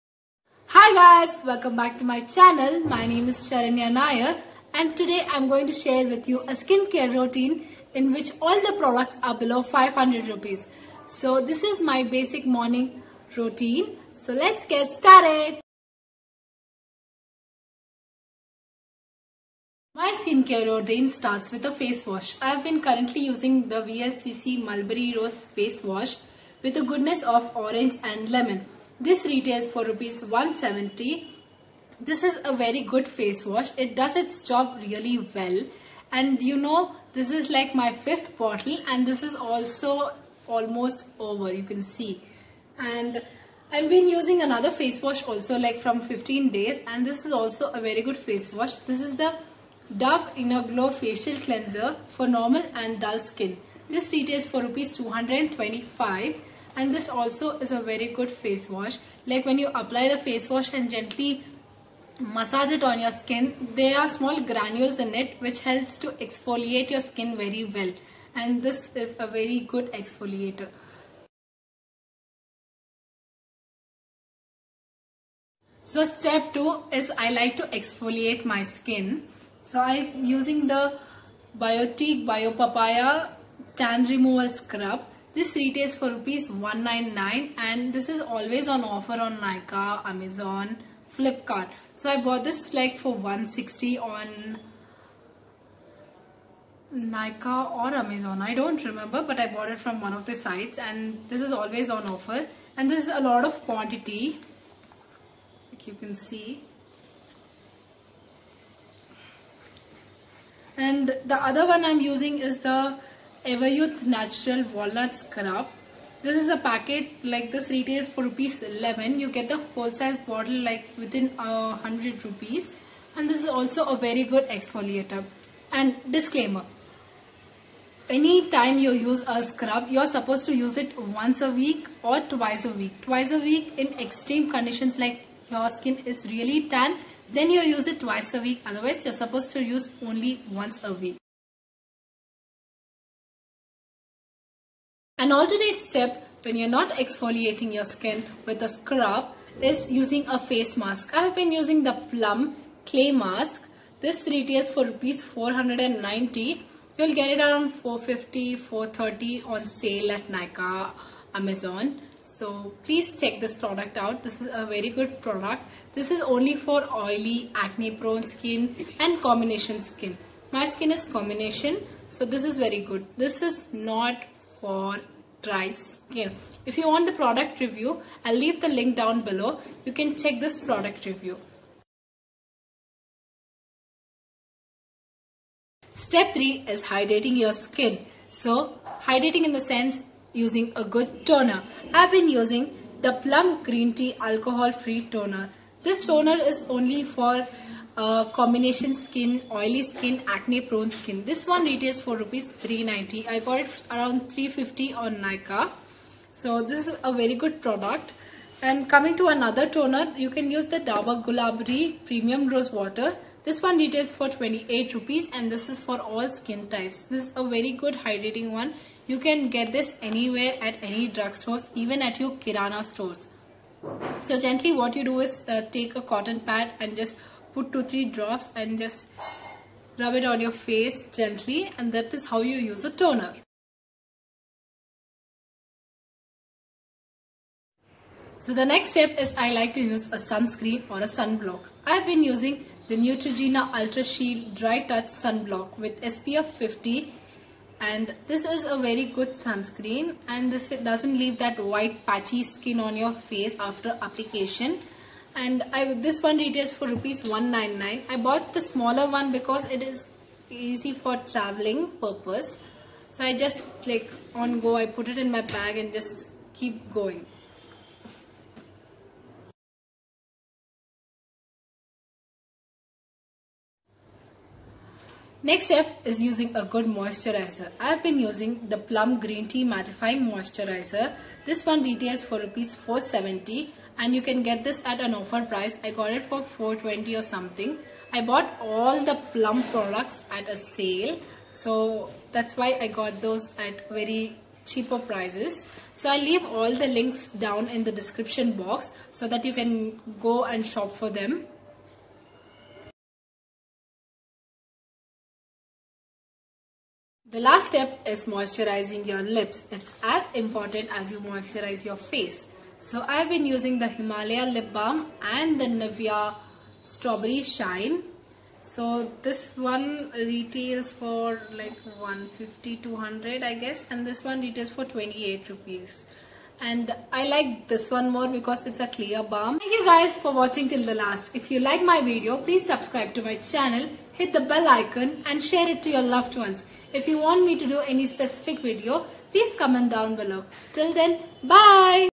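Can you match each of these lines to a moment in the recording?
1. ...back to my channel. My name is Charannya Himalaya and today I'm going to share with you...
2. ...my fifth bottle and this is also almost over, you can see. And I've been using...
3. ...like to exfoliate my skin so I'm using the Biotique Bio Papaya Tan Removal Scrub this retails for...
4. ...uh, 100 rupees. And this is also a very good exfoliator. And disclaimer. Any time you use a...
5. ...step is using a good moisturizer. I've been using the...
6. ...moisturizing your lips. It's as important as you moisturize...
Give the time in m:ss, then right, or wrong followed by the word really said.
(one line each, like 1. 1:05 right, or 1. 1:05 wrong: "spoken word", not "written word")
1. 0:01 wrong: "Nair", not "Himalaya"
2. 0:37 right
3. 1:17 right
4. 2:01 right
5. 4:35 right
6. 5:08 right.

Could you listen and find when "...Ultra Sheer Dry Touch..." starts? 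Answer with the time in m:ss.
4:03.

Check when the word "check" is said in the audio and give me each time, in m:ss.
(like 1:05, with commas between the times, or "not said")
2:43, 3:00.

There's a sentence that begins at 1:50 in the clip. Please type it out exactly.
And the other one I'm using is the Everyuth Natural Walnut Scrub.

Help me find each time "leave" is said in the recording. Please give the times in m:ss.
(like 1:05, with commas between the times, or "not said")
2:58, 4:11, 4:56.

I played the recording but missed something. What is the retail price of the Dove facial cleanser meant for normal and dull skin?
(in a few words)
225 rupees.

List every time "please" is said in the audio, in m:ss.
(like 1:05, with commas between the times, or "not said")
2:42, 5:32, 5:39.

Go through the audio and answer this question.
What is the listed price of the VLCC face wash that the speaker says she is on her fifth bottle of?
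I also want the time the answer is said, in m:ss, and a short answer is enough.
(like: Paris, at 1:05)
170 rupees, at 0:29.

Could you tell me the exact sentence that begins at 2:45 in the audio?
This is only for oily, acne prone skin and combination skin.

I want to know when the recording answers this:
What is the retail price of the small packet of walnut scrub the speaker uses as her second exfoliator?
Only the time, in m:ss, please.
1:58.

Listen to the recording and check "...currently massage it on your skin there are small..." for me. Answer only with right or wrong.
wrong.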